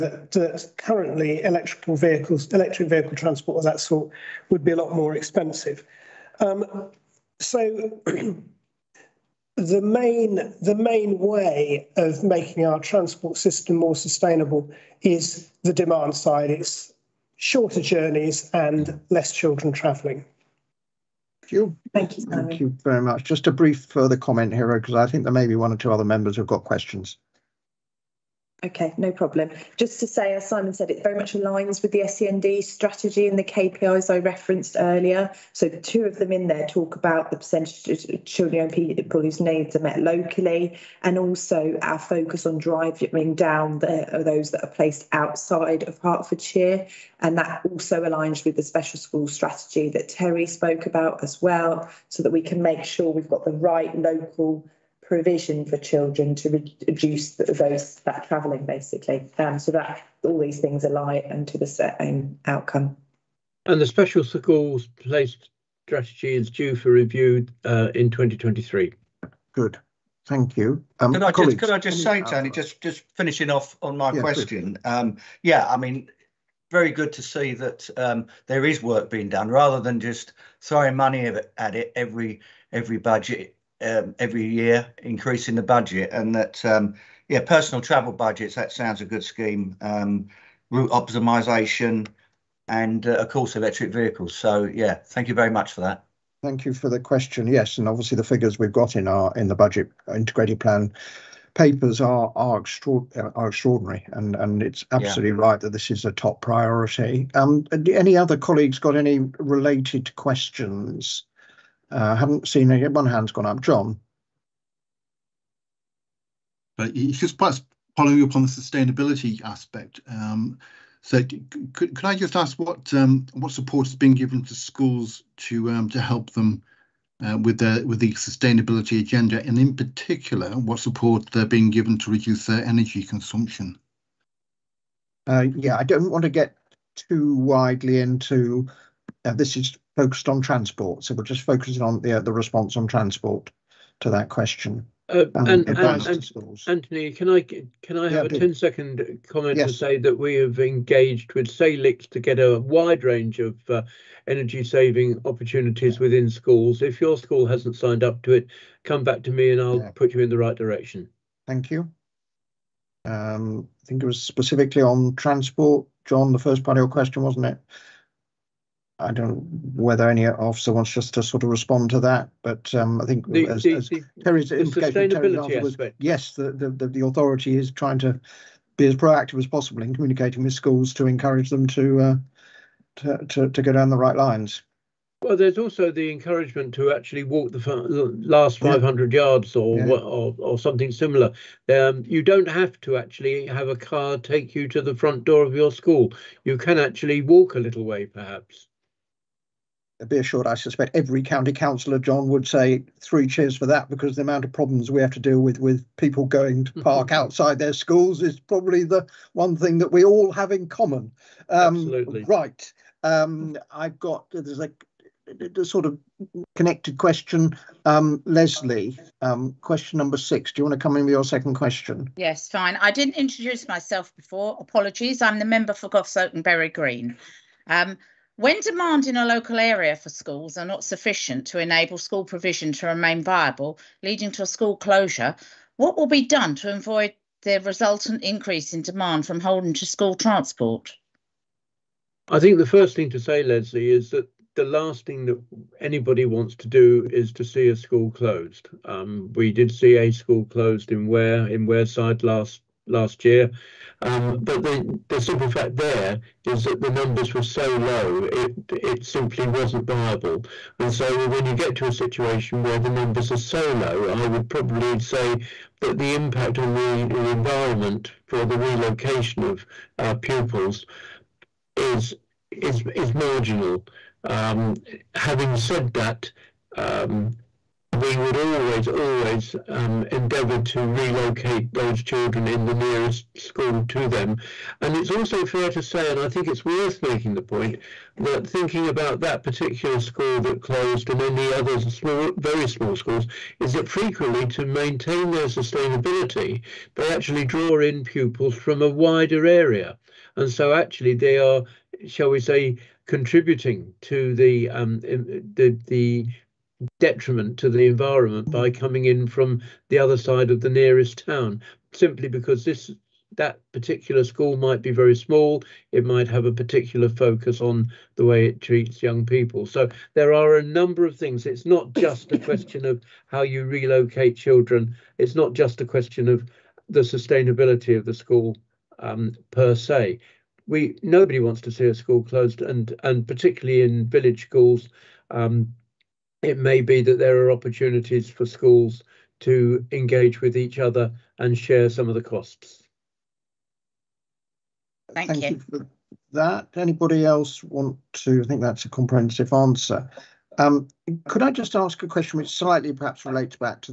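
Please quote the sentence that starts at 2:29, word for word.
to say that we have engaged with Salix to get a wide range of uh, energy saving opportunities yeah.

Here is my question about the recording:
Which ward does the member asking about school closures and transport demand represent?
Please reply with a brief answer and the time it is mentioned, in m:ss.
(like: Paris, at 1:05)
Goss and Bury Green, at 3:45.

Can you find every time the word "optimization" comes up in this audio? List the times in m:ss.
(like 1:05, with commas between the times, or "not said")
1:30.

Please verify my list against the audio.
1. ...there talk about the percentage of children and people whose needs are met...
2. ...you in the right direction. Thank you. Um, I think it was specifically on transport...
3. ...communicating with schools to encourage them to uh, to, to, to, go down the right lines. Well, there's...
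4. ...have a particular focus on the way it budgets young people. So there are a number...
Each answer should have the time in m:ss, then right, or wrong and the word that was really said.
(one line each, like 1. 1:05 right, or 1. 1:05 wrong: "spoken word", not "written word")
1. 0:36 right
2. 2:40 right
3. 2:59 right
4. 5:16 wrong: "treats", not "budgets".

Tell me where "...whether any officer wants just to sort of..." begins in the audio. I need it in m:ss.
2:49.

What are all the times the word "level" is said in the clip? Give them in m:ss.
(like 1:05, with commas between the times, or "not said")
not said.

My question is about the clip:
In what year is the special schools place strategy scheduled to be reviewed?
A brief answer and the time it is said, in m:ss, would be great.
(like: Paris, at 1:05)
2023, at 1:08.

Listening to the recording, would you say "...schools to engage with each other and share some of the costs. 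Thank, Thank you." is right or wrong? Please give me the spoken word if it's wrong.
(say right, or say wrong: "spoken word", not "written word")
right.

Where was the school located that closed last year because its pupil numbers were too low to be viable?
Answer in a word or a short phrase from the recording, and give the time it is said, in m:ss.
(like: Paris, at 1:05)
Wareside, at 4:11.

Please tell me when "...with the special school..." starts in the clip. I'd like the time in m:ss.
0:48.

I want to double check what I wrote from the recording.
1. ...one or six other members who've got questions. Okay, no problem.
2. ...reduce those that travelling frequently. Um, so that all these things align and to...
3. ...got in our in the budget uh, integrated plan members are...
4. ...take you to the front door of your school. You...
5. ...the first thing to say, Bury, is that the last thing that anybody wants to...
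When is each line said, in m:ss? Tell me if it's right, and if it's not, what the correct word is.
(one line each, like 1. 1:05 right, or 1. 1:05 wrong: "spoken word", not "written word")
1. 0:25 wrong: "two", not "six"
2. 0:56 wrong: "basically", not "frequently"
3. 1:38 wrong: "papers", not "members"
4. 3:14 right
5. 4:02 wrong: "Leslie", not "Bury".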